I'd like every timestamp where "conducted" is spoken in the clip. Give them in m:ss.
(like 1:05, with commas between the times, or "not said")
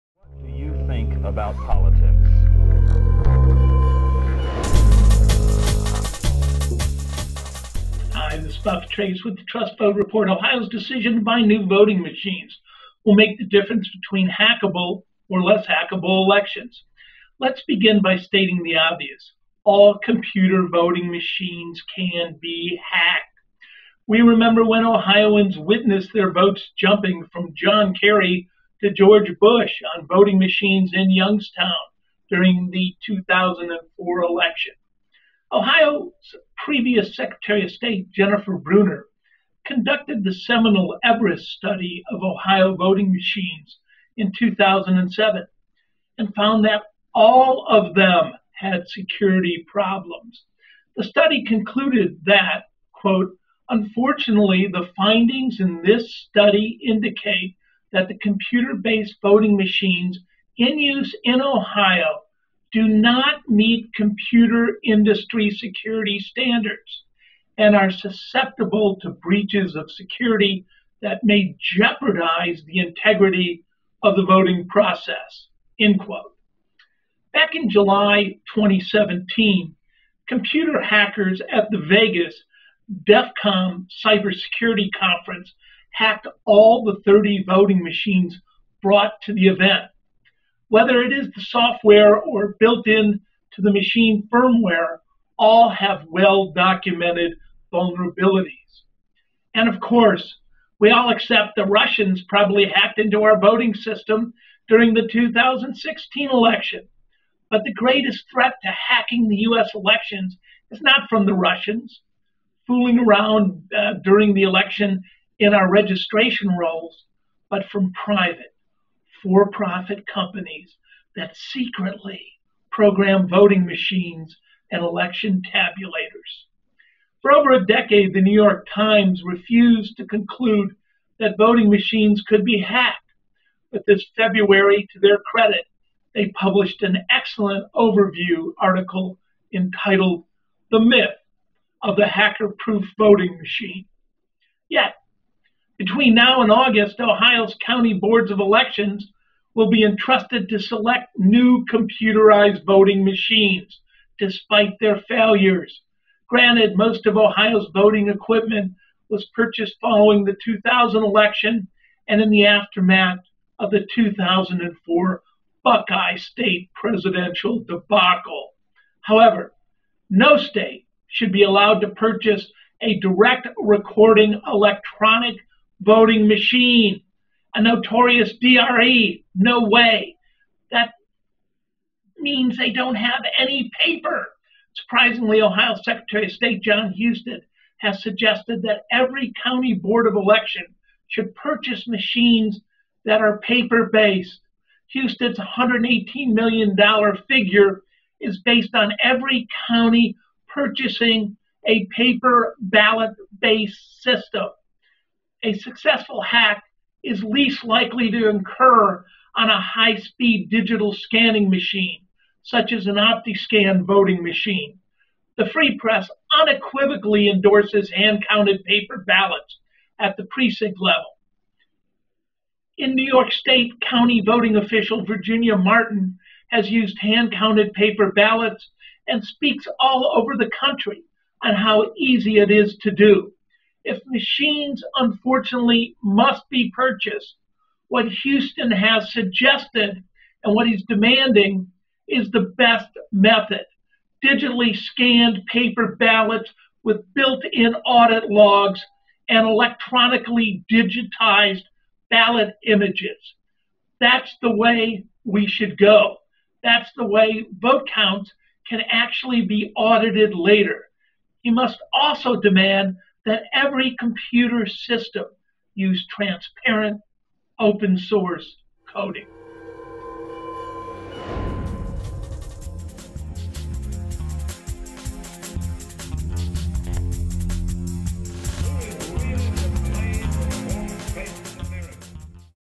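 0:39.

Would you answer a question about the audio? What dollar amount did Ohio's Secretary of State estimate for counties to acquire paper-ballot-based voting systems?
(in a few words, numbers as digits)
$118 million.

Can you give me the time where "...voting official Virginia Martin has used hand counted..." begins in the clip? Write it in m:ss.
3:44.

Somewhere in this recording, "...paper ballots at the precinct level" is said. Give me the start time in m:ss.
3:38.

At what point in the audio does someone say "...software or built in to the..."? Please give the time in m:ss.
1:31.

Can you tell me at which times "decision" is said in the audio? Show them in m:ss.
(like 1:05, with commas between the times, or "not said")
0:10.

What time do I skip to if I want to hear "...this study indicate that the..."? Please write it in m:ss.
0:55.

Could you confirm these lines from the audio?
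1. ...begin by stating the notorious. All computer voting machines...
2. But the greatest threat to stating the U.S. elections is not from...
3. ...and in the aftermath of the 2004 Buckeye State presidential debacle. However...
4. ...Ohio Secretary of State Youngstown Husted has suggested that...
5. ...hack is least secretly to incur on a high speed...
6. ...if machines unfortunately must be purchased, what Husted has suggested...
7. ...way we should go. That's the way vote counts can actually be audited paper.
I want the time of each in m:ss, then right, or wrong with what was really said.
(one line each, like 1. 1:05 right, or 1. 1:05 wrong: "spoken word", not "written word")
1. 0:17 wrong: "obvious", not "notorious"
2. 1:47 wrong: "hacking", not "stating"
3. 2:42 right
4. 3:05 wrong: "John", not "Youngstown"
5. 3:26 wrong: "likely", not "secretly"
6. 3:53 right
7. 4:14 wrong: "later", not "paper".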